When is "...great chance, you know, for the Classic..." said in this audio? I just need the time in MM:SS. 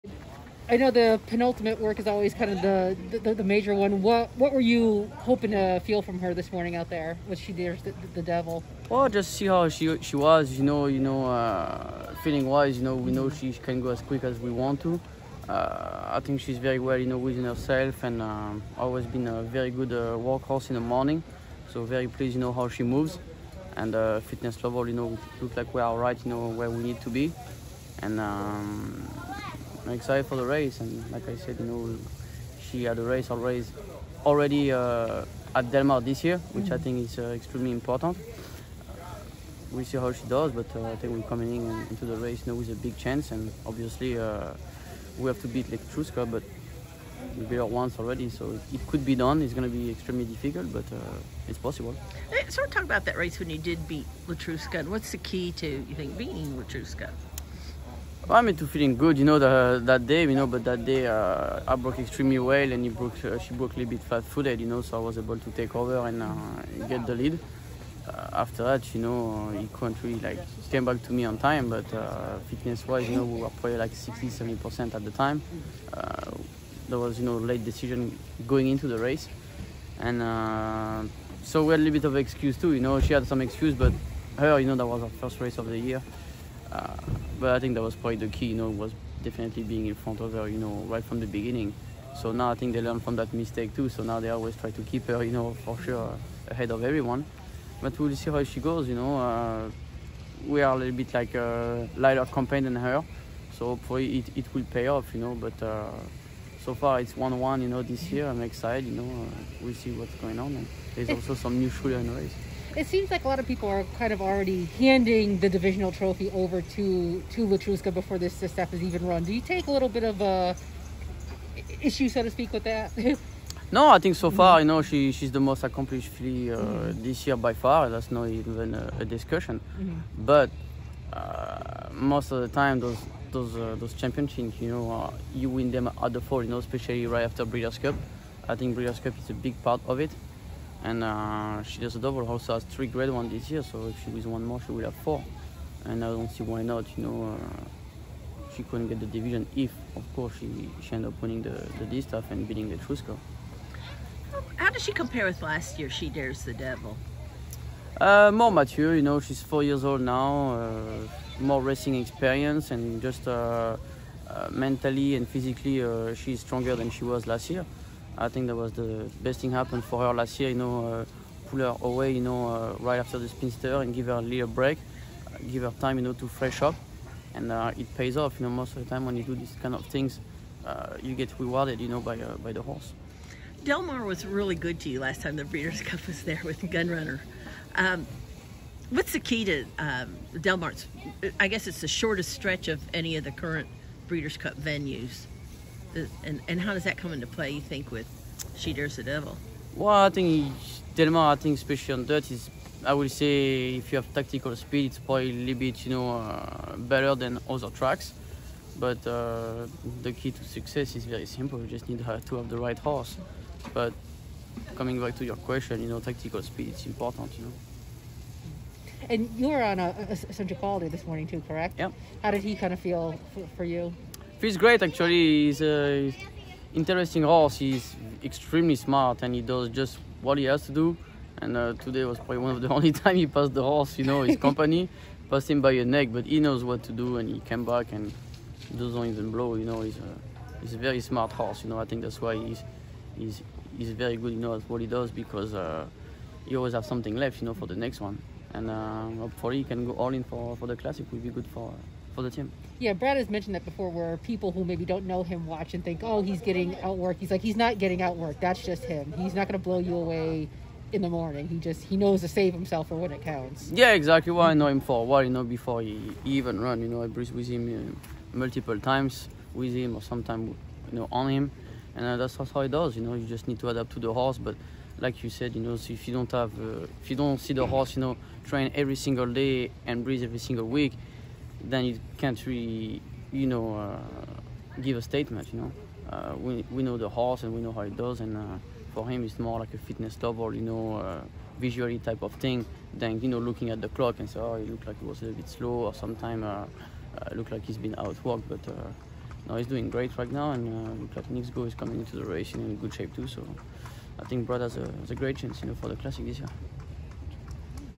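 05:05.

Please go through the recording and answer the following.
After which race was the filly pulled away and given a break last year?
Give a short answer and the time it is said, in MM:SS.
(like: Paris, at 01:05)
the Spinster, at 02:53.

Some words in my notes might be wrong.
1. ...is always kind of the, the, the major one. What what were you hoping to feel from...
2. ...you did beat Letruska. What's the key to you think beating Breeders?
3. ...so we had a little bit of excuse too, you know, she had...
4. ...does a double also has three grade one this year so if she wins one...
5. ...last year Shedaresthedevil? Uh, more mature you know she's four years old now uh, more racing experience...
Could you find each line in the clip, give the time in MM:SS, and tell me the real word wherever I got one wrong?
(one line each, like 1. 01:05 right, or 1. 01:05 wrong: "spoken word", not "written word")
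1. 00:01 right
2. 00:53 wrong: "Letruska", not "Breeders"
3. 01:21 right
4. 02:21 right
5. 02:35 right.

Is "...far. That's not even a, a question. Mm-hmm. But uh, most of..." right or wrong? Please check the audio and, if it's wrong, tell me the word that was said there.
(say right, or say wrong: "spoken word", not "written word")
wrong: "discussion", not "question".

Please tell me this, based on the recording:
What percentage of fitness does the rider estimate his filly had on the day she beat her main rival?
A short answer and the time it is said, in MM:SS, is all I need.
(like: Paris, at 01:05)
60-70%, at 01:13.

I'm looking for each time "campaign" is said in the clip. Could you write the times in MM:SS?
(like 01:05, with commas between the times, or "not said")
01:42.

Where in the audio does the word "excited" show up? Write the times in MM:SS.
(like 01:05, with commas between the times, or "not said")
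00:29, 01:48.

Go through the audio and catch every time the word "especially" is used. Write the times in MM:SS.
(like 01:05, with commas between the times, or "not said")
02:16, 03:21.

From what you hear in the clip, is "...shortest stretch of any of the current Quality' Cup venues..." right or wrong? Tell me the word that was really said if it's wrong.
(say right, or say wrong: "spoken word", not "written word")
wrong: "Breeders", not "Quality".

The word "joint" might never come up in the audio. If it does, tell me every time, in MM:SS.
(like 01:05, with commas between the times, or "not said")
not said.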